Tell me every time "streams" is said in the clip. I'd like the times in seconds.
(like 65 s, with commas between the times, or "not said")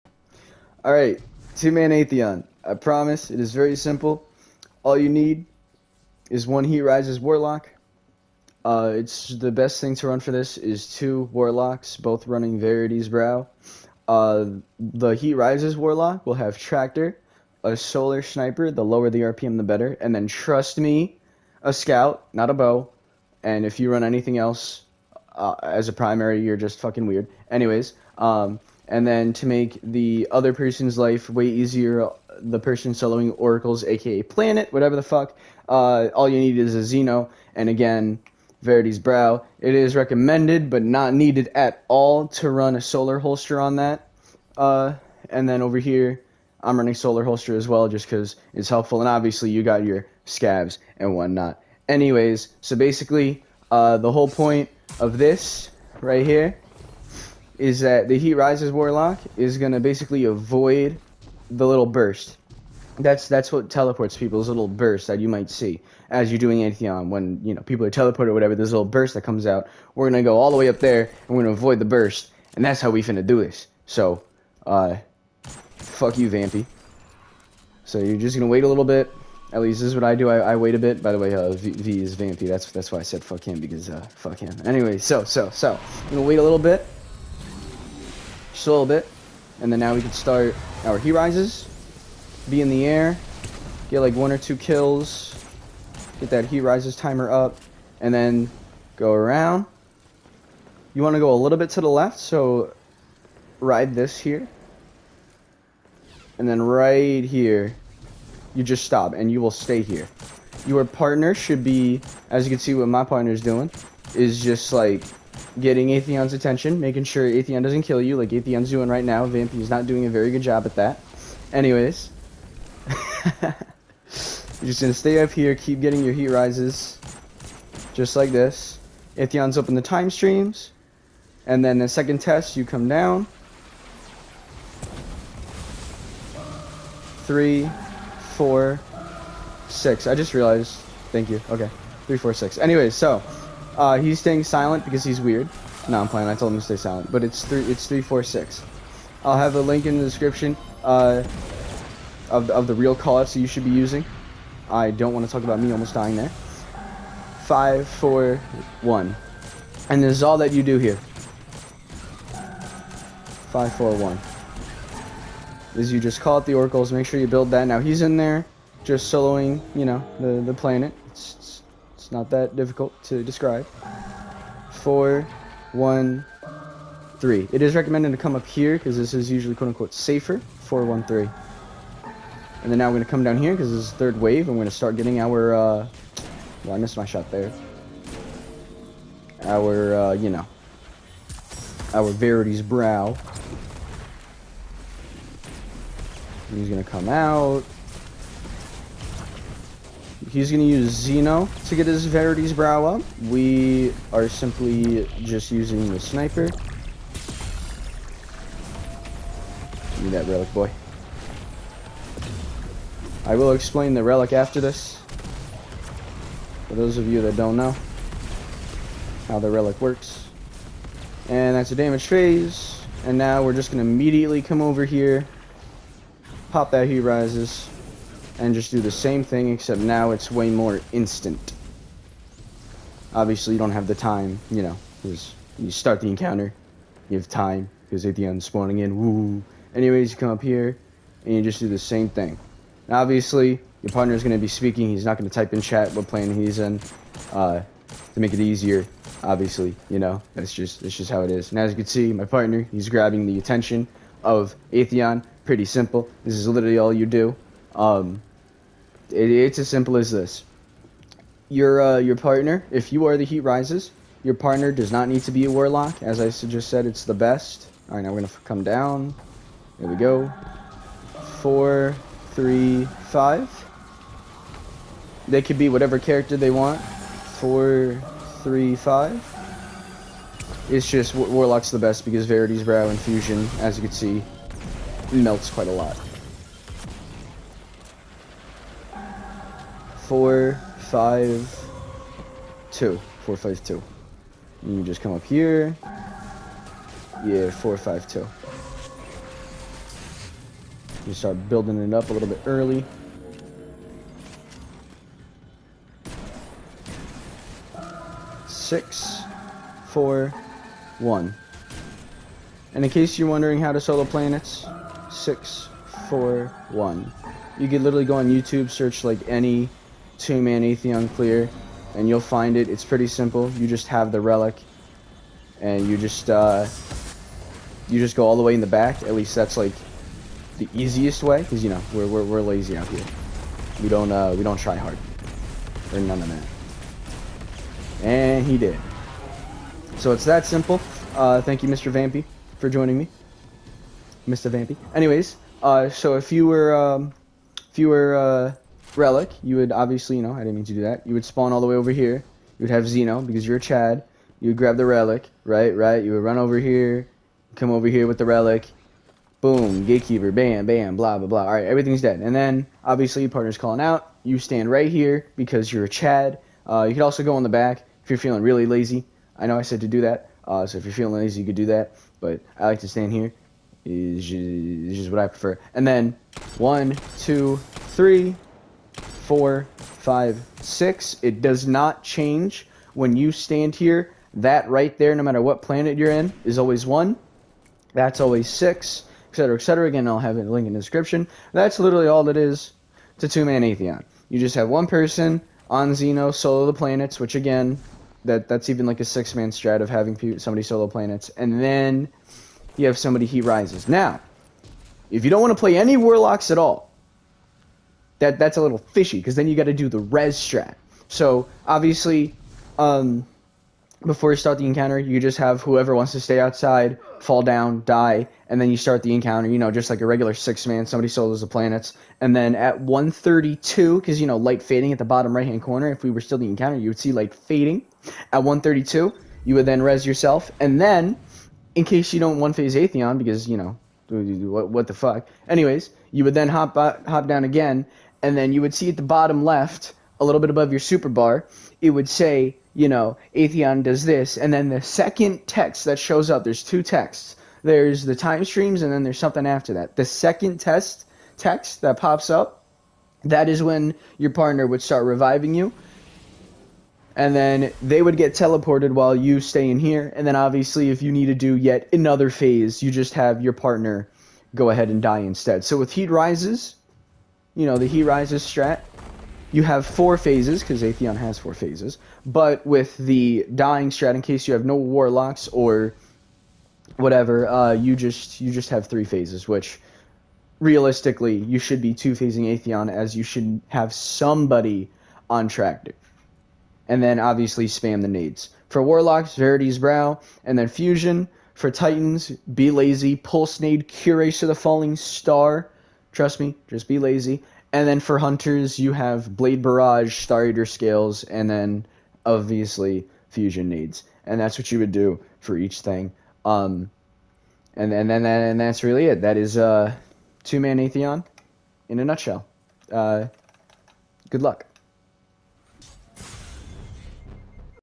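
130 s, 448 s.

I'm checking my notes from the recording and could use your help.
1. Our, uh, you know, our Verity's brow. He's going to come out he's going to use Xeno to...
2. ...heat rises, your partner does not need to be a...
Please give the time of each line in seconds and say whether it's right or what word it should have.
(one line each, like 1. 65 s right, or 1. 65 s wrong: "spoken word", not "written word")
1. 189 s right
2. 263 s right.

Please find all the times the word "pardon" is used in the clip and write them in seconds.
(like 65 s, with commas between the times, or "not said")
not said.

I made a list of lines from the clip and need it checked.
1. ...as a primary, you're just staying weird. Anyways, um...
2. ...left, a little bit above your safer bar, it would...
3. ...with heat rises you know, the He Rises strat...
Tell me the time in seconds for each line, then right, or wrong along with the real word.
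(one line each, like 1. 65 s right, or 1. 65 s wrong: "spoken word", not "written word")
1. 25 s wrong: "fucking", not "staying"
2. 439 s wrong: "super", not "safer"
3. 465 s right.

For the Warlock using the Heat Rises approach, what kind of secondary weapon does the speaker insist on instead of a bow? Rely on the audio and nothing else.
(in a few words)
Scout.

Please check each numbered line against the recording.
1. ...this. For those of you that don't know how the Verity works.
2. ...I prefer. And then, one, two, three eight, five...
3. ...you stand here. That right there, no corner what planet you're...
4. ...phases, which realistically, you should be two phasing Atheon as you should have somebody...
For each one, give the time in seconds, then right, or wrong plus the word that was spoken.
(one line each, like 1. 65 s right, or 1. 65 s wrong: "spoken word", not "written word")
1. 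214 s wrong: "Relic", not "Verity"
2. 375 s wrong: "four", not "eight"
3. 383 s wrong: "matter", not "corner"
4. 479 s right.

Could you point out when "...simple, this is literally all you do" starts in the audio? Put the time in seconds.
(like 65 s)
255 s.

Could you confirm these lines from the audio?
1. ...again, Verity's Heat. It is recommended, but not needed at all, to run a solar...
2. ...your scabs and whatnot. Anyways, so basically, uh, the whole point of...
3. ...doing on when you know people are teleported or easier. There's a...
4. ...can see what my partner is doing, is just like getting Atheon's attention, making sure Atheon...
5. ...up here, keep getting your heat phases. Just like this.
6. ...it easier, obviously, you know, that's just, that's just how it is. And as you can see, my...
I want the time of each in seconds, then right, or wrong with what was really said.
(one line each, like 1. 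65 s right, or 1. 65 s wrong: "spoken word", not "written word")
1. 37 s wrong: "Brow", not "Heat"
2. 49 s right
3. 66 s wrong: "whatever", not "easier"
4. 112 s right
5. 125 s wrong: "rises", not "phases"
6. 248 s right.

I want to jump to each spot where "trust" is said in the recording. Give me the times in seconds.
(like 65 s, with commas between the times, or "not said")
20 s, 496 s.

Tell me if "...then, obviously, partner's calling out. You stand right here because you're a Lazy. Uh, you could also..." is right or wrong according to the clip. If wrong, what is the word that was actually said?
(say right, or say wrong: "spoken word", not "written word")
wrong: "Chad", not "Lazy".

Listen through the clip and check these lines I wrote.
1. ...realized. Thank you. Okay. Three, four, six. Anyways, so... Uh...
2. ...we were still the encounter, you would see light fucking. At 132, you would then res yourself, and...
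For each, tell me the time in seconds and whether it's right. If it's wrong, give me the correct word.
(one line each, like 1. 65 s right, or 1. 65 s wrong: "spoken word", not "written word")
1. 140 s right
2. 426 s wrong: "fading", not "fucking".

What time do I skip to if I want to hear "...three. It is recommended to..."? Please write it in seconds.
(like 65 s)
177 s.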